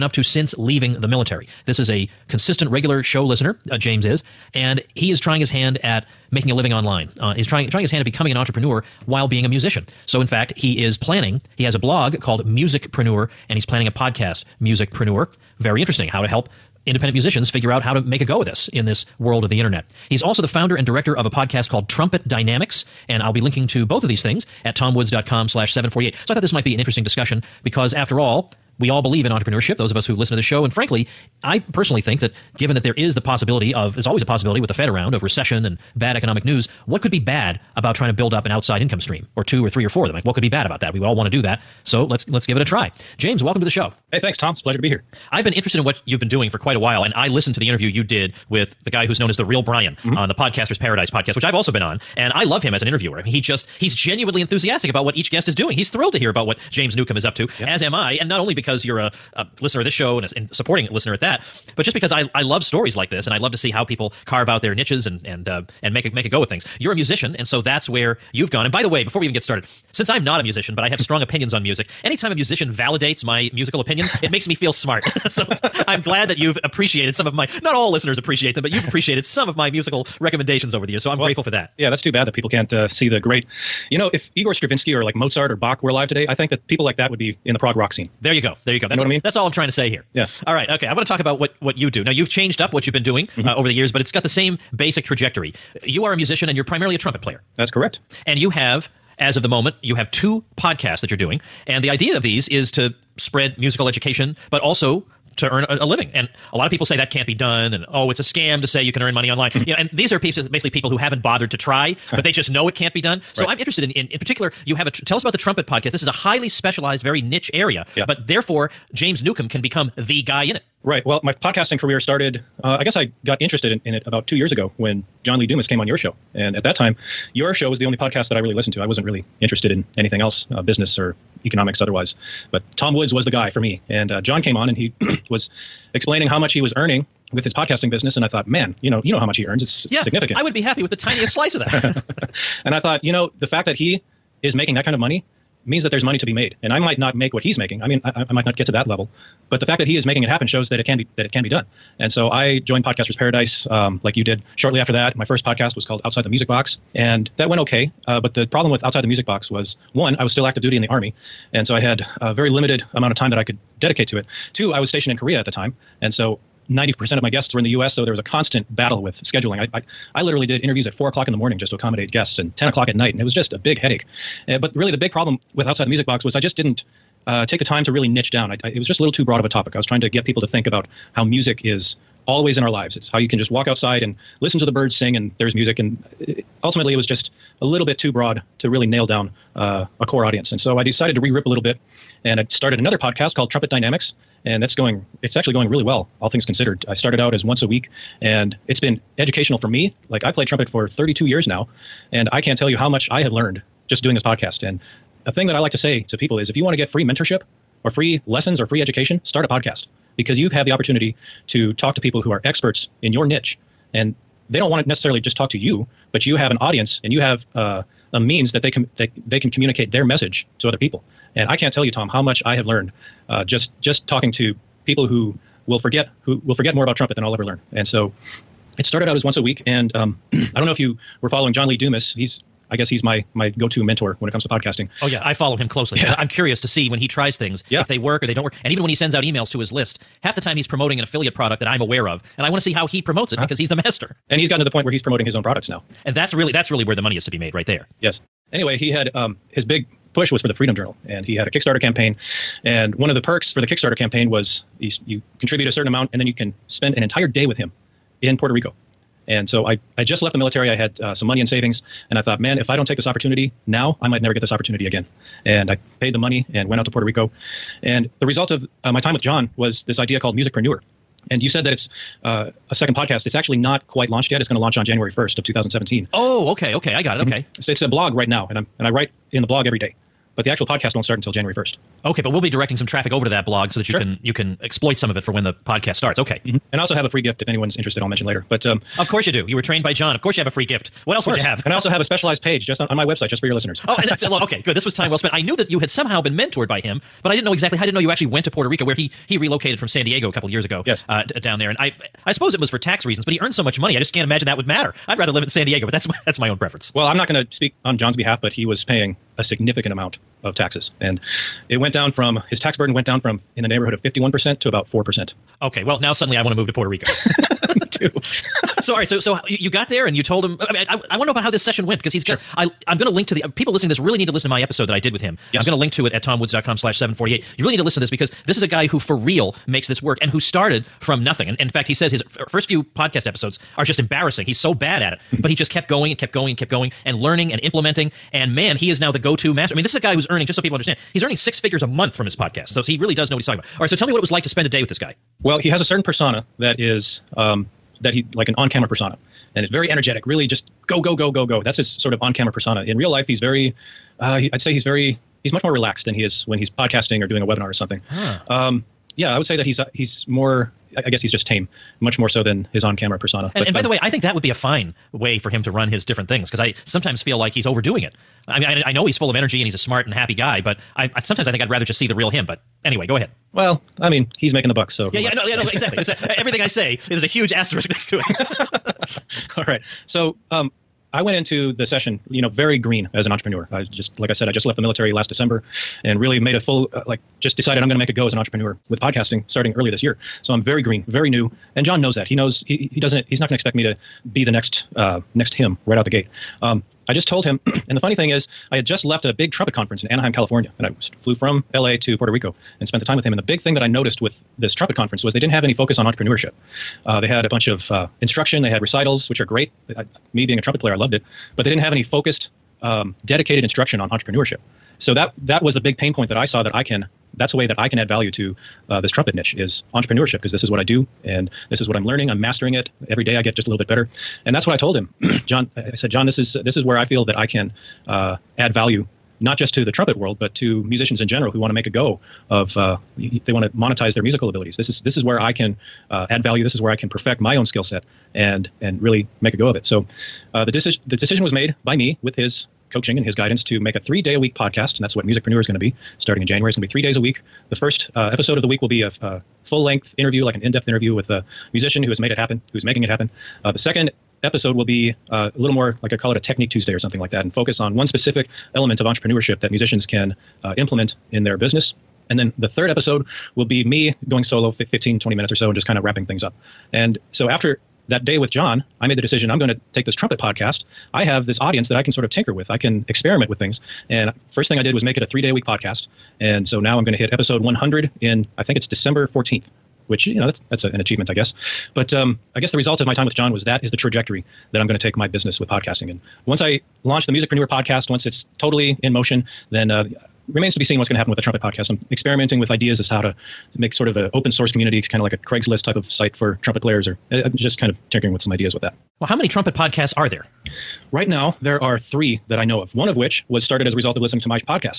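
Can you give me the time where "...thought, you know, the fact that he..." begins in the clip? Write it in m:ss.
2:22.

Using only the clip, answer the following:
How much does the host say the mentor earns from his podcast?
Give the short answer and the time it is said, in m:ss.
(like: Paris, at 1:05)
Six figures a month, at 5:41.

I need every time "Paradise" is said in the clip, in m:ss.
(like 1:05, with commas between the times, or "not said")
0:50, 2:33.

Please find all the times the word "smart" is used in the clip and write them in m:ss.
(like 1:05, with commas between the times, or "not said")
1:14, 6:09.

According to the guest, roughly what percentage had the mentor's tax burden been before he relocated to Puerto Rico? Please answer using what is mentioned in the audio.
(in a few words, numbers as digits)
51%.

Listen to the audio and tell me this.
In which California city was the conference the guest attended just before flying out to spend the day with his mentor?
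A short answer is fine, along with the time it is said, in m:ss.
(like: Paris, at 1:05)
Anaheim, at 6:40.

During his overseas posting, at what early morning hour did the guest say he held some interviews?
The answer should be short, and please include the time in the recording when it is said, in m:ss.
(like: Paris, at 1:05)
4 o'clock, at 2:50.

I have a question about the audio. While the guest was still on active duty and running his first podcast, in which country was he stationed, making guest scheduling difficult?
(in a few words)
Korea.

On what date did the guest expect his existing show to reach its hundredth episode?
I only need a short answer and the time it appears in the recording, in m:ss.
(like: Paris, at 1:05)
December 14, at 7:58.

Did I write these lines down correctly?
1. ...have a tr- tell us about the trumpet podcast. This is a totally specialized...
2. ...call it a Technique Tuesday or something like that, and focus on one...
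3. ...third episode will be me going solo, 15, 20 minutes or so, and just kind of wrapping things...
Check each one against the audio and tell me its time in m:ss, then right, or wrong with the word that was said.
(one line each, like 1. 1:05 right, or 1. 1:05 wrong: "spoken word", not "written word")
1. 1:54 wrong: "highly", not "totally"
2. 7:36 right
3. 7:42 right.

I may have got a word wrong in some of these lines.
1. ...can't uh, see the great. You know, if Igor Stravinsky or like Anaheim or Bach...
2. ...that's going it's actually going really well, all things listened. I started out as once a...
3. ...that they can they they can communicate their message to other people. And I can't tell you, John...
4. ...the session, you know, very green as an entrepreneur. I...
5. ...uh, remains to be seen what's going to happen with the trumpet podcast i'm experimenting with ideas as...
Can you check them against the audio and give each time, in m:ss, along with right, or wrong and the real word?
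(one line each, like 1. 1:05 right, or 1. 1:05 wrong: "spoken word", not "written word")
1. 1:22 wrong: "Mozart", not "Anaheim"
2. 3:14 wrong: "considered", not "listened"
3. 3:38 wrong: "Tom", not "John"
4. 6:21 right
5. 8:09 right.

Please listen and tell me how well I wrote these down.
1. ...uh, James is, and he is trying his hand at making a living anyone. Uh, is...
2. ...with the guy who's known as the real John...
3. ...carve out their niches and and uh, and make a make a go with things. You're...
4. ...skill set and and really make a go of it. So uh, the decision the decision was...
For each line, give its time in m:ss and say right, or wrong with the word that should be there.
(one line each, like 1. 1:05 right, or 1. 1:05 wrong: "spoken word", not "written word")
1. 0:03 wrong: "online", not "anyone"
2. 0:48 wrong: "Brian", not "John"
3. 1:04 right
4. 7:17 right.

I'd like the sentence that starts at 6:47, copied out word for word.
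Uh, they had a bunch of uh, instruction.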